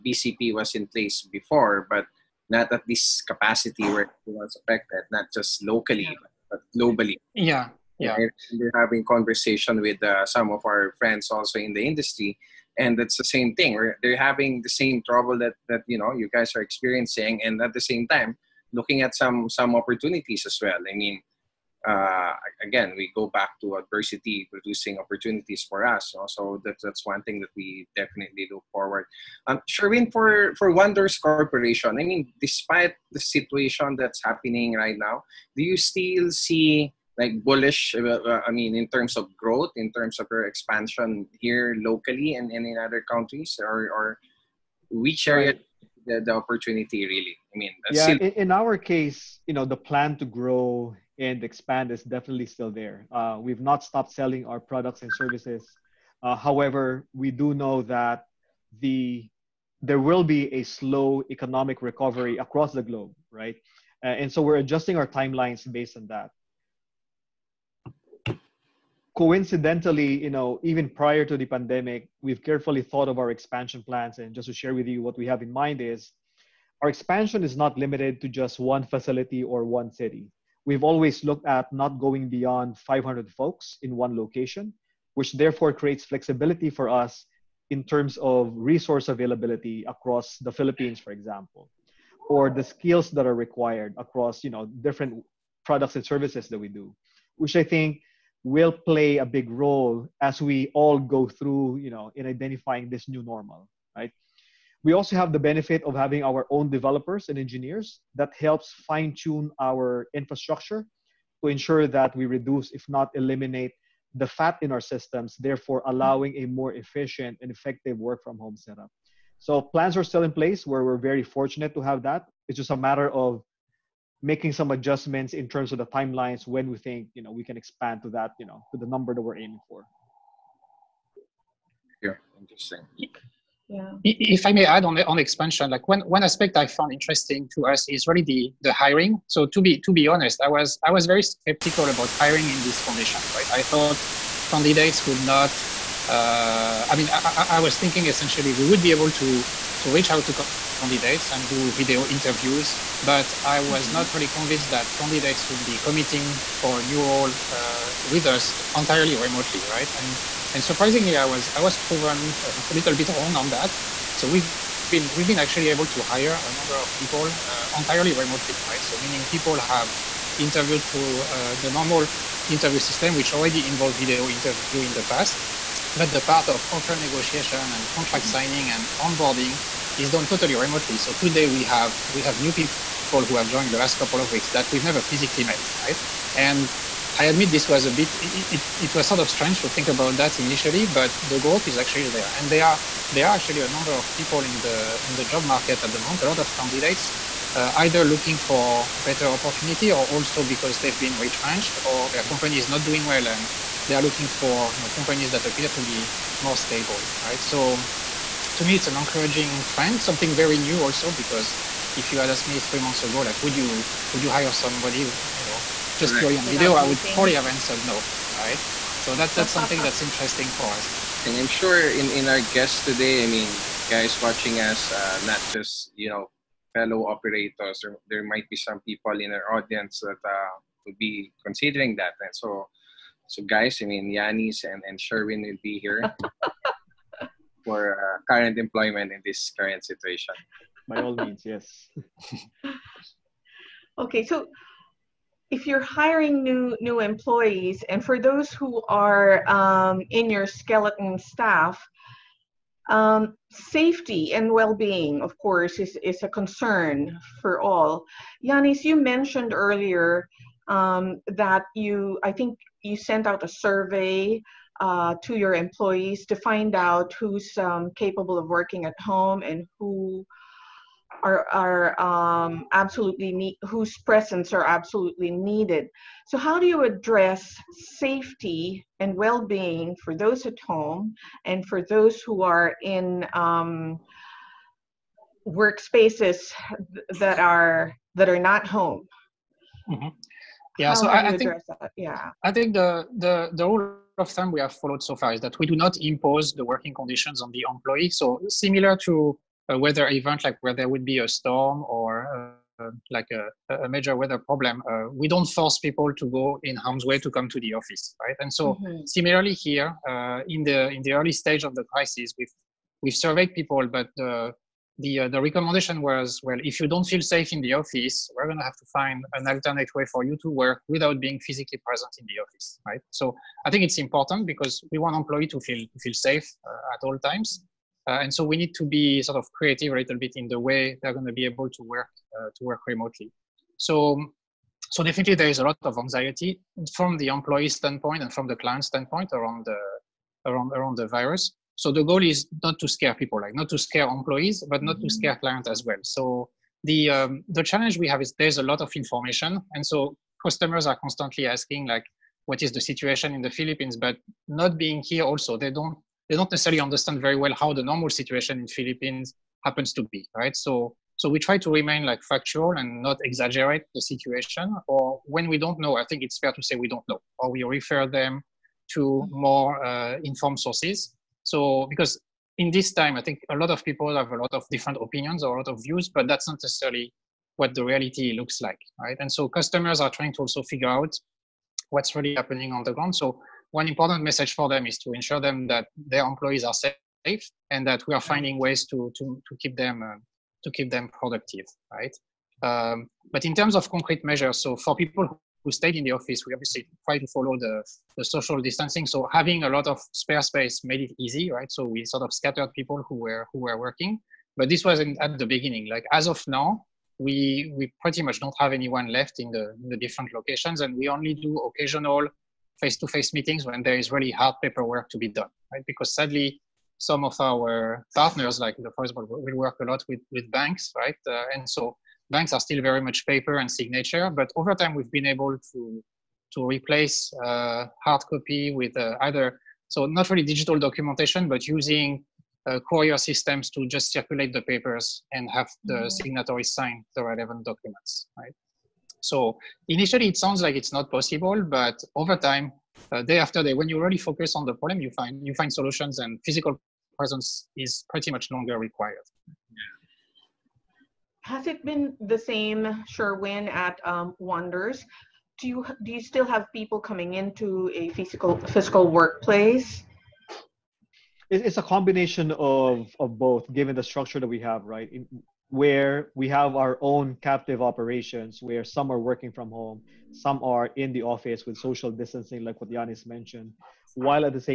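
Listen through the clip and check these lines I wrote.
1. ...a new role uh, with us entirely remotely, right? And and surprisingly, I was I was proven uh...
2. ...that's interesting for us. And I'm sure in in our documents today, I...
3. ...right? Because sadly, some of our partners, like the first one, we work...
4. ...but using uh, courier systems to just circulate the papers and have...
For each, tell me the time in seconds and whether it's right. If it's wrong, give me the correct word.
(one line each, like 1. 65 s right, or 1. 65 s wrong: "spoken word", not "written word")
1. 156 s right
2. 219 s wrong: "guests", not "documents"
3. 415 s right
4. 431 s right.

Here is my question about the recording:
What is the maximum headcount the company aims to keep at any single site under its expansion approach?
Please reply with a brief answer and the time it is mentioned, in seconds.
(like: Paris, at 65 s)
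500, at 82 s.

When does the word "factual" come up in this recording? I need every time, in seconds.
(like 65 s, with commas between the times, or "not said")
362 s.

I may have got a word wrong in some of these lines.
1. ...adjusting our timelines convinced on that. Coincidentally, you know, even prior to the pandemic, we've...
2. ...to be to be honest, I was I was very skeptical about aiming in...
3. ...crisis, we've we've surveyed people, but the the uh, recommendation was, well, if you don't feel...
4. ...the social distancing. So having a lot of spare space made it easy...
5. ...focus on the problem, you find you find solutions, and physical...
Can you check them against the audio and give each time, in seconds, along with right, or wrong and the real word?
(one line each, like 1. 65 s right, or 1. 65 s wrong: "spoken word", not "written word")
1. 64 s wrong: "based", not "convinced"
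2. 139 s wrong: "hiring", not "aiming"
3. 311 s right
4. 398 s right
5. 444 s right.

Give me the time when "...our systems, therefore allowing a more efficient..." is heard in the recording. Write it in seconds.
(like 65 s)
114 s.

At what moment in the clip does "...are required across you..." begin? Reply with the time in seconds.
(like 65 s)
93 s.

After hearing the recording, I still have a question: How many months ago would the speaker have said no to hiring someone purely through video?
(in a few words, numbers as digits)
3 months.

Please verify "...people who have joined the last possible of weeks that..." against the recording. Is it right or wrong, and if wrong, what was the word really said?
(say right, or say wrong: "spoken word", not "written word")
wrong: "couple", not "possible".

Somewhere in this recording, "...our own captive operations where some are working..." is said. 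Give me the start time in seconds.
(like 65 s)
466 s.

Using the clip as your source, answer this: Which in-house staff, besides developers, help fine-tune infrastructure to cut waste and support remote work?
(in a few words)
engineers.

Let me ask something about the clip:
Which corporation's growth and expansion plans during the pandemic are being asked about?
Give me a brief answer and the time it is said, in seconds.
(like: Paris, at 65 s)
Wonders Corporation, at 30 s.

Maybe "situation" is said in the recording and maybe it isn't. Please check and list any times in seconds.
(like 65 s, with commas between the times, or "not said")
33 s, 239 s, 352 s, 358 s, 363 s.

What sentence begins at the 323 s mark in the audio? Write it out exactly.
So I think it's important because we want employees to feel to feel safe uh, at all times.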